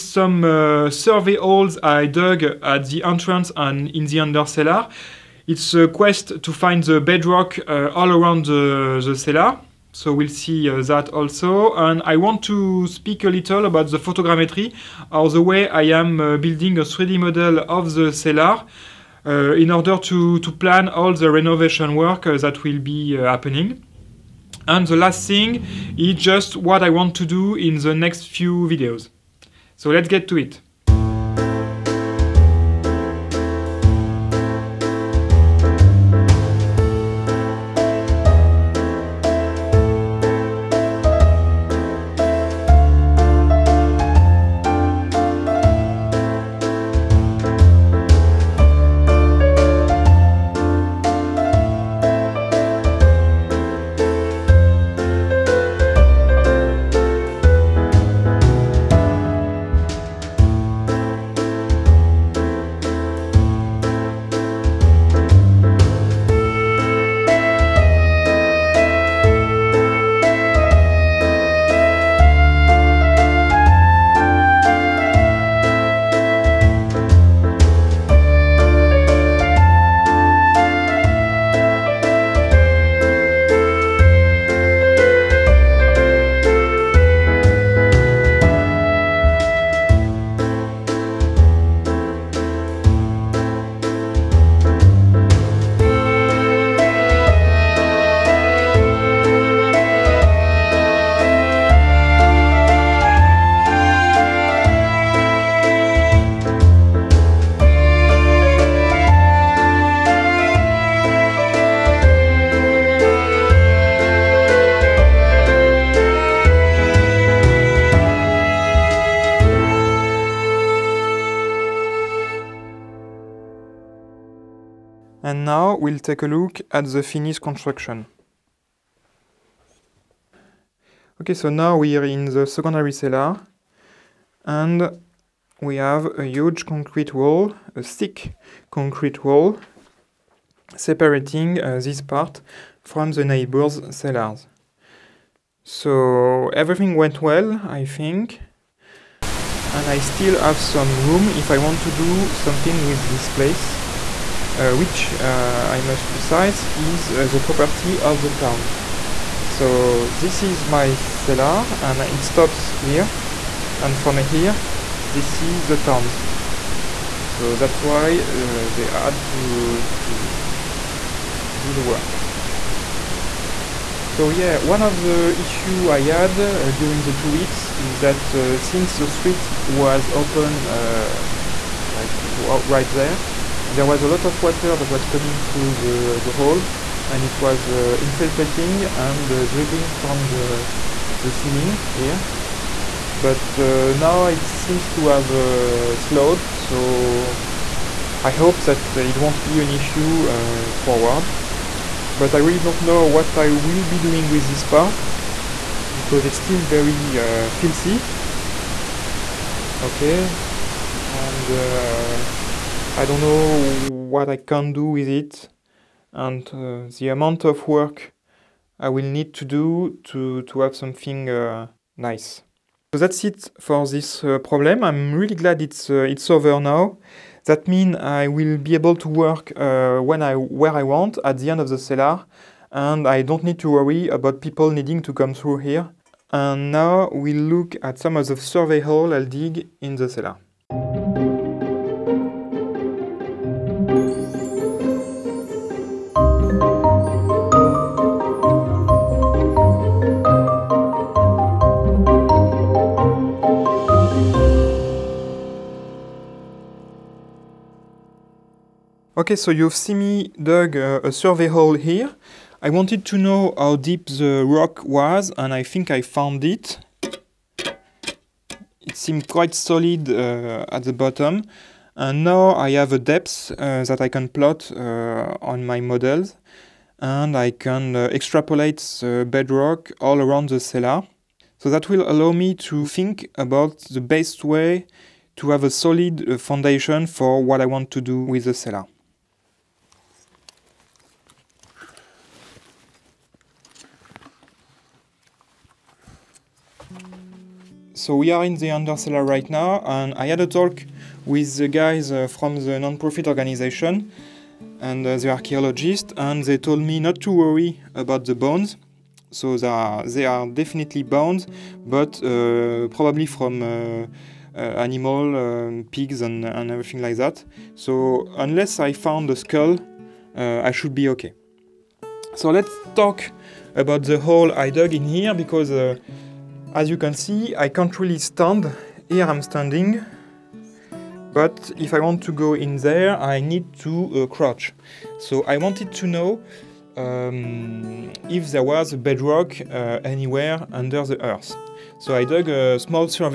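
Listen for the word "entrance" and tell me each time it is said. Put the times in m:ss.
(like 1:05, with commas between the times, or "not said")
0:03.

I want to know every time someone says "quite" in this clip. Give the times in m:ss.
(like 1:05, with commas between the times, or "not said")
4:29.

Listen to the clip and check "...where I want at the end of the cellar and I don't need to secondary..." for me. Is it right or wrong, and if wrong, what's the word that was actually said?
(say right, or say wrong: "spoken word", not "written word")
wrong: "worry", not "secondary".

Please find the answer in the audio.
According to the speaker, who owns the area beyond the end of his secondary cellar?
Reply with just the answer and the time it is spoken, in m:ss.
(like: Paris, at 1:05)
The town, at 2:38.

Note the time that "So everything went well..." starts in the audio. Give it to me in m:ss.
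2:25.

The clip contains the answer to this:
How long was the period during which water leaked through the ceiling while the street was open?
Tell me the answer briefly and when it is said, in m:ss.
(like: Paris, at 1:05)
Two weeks, at 2:57.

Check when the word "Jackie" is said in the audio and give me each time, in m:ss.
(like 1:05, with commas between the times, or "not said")
not said.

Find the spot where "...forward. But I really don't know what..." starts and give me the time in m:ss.
3:20.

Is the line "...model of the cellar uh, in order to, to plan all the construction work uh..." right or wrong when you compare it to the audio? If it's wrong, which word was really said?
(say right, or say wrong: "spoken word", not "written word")
wrong: "renovation", not "construction".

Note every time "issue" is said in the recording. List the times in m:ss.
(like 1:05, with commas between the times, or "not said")
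2:55, 3:19.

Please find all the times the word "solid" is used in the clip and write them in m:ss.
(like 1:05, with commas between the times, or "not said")
4:29, 4:45.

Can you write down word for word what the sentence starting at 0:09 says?
So we'll see uh, that also.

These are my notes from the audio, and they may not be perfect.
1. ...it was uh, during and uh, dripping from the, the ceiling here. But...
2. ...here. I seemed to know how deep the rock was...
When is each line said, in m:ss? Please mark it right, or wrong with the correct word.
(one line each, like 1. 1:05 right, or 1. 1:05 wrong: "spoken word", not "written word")
1. 3:07 wrong: "infiltrating", not "during"
2. 4:21 wrong: "wanted", not "seemed".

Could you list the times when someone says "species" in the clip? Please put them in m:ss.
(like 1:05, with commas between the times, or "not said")
not said.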